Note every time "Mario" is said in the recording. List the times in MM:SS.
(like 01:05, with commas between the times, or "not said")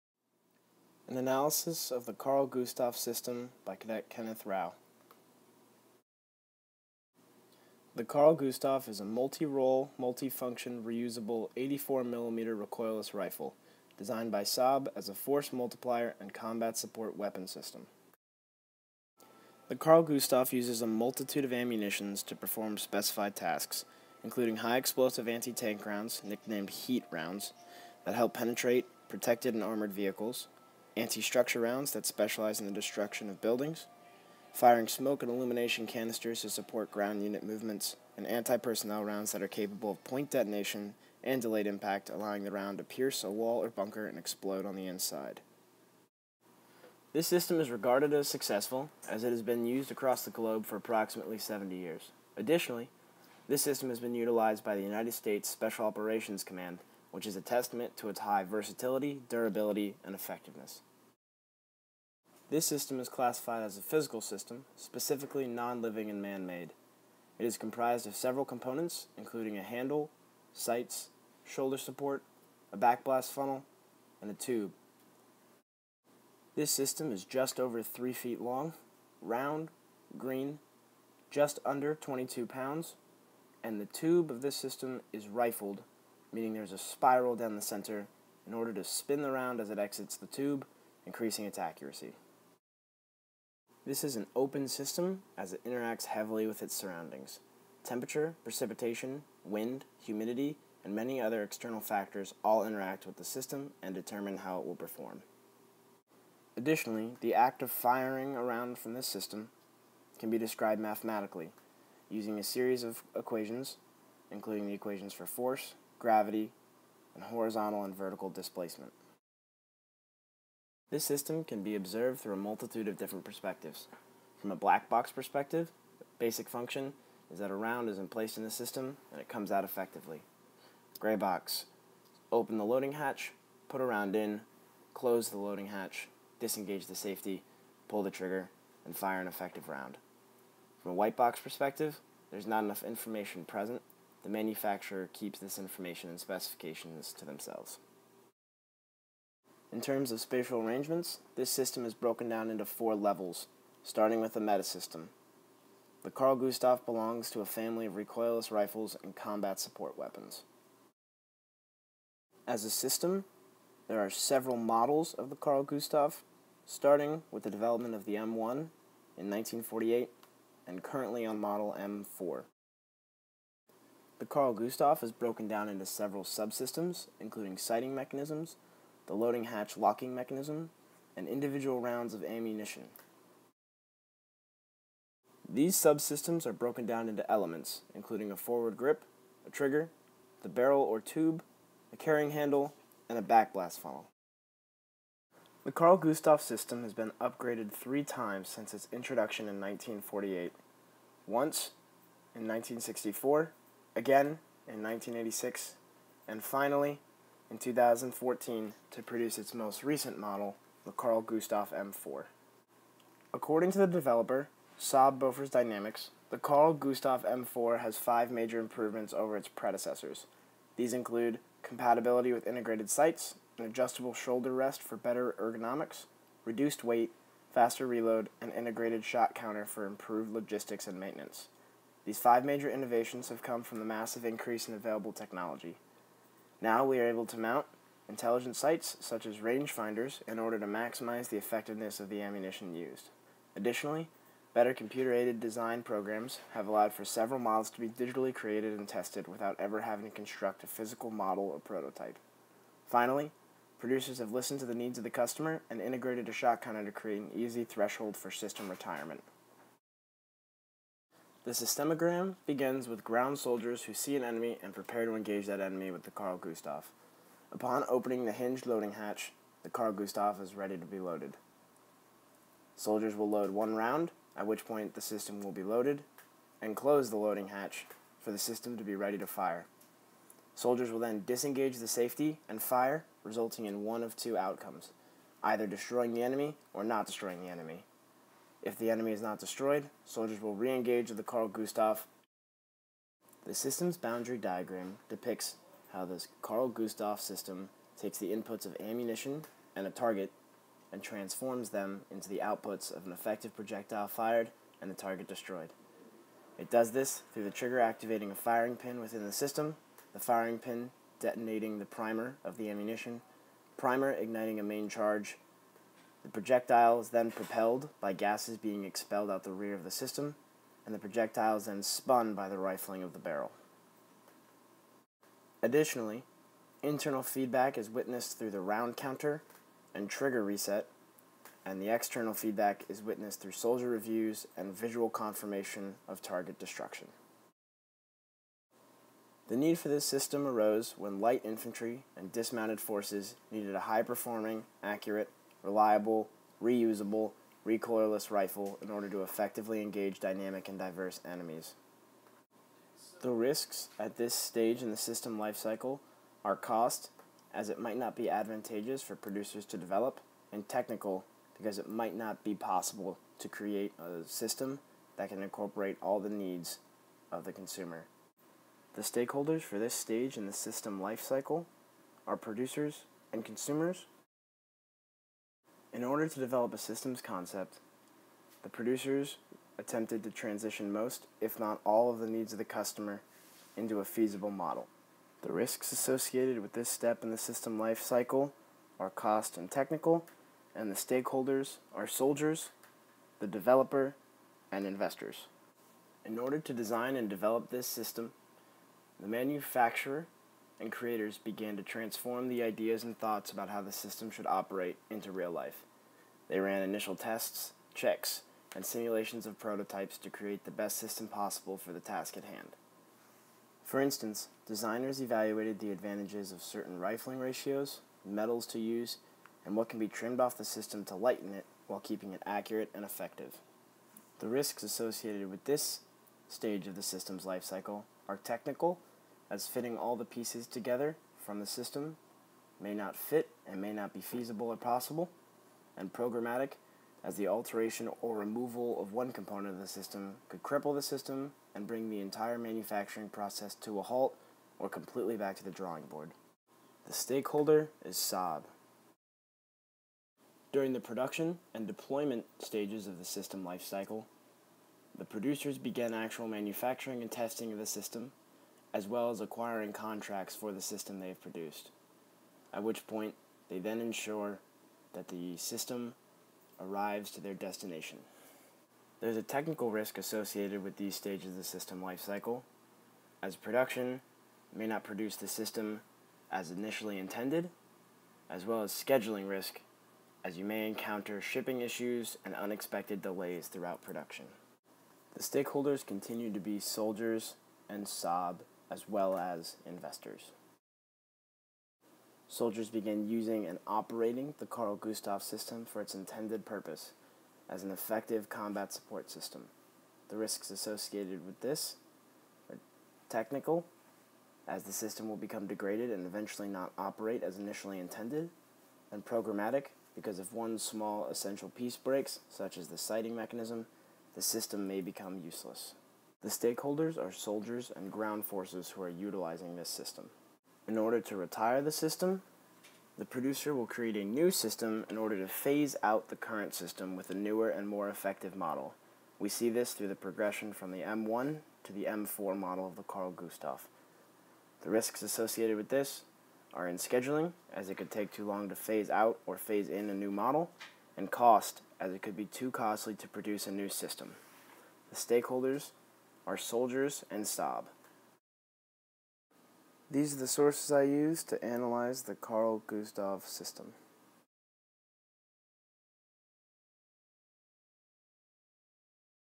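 not said.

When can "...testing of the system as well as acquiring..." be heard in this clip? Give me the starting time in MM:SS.
07:37.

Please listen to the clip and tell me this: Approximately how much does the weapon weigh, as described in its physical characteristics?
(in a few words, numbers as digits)
just under 22 pounds.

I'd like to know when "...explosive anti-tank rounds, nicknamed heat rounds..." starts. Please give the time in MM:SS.
00:24.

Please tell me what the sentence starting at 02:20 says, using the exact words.
From a white box perspective, there's not enough information present the manufacturer keeps this information and specifications to themselves.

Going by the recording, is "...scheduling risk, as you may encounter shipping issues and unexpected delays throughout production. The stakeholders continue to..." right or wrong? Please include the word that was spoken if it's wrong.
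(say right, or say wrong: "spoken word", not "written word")
right.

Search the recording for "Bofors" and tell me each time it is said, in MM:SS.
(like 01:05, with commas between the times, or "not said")
03:35.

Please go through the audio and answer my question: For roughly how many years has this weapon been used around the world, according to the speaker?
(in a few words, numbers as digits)
70 years.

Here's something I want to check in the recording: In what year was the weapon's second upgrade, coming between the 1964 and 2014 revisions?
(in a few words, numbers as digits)
1986.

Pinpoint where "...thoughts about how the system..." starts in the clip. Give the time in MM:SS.
06:43.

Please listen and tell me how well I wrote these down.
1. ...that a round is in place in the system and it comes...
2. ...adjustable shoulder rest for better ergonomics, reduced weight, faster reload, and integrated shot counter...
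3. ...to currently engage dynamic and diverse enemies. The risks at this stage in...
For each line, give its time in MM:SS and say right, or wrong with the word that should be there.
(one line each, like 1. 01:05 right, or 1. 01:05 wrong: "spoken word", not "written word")
1. 02:07 right
2. 03:43 right
3. 05:49 wrong: "effectively", not "currently".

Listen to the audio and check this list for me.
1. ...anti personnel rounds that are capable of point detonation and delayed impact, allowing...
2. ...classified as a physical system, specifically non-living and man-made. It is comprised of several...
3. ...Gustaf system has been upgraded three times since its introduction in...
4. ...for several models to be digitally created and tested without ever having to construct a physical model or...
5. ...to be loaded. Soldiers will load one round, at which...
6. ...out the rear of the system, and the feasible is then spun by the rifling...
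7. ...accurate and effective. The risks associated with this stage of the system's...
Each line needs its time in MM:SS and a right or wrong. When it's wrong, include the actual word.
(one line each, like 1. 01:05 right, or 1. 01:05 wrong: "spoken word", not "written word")
1. 00:38 right
2. 01:03 right
3. 03:15 right
4. 04:06 right
5. 04:30 right
6. 05:19 wrong: "projectile", not "feasible"
7. 07:02 right.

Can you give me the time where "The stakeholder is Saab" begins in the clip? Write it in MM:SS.
07:27.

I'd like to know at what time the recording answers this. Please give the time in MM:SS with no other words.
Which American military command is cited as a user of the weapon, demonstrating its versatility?
00:54.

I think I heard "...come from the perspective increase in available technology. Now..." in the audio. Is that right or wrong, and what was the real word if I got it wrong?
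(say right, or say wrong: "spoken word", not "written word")
wrong: "massive", not "perspective".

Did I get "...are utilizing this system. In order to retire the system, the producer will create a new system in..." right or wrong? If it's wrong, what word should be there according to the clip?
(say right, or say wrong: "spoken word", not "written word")
right.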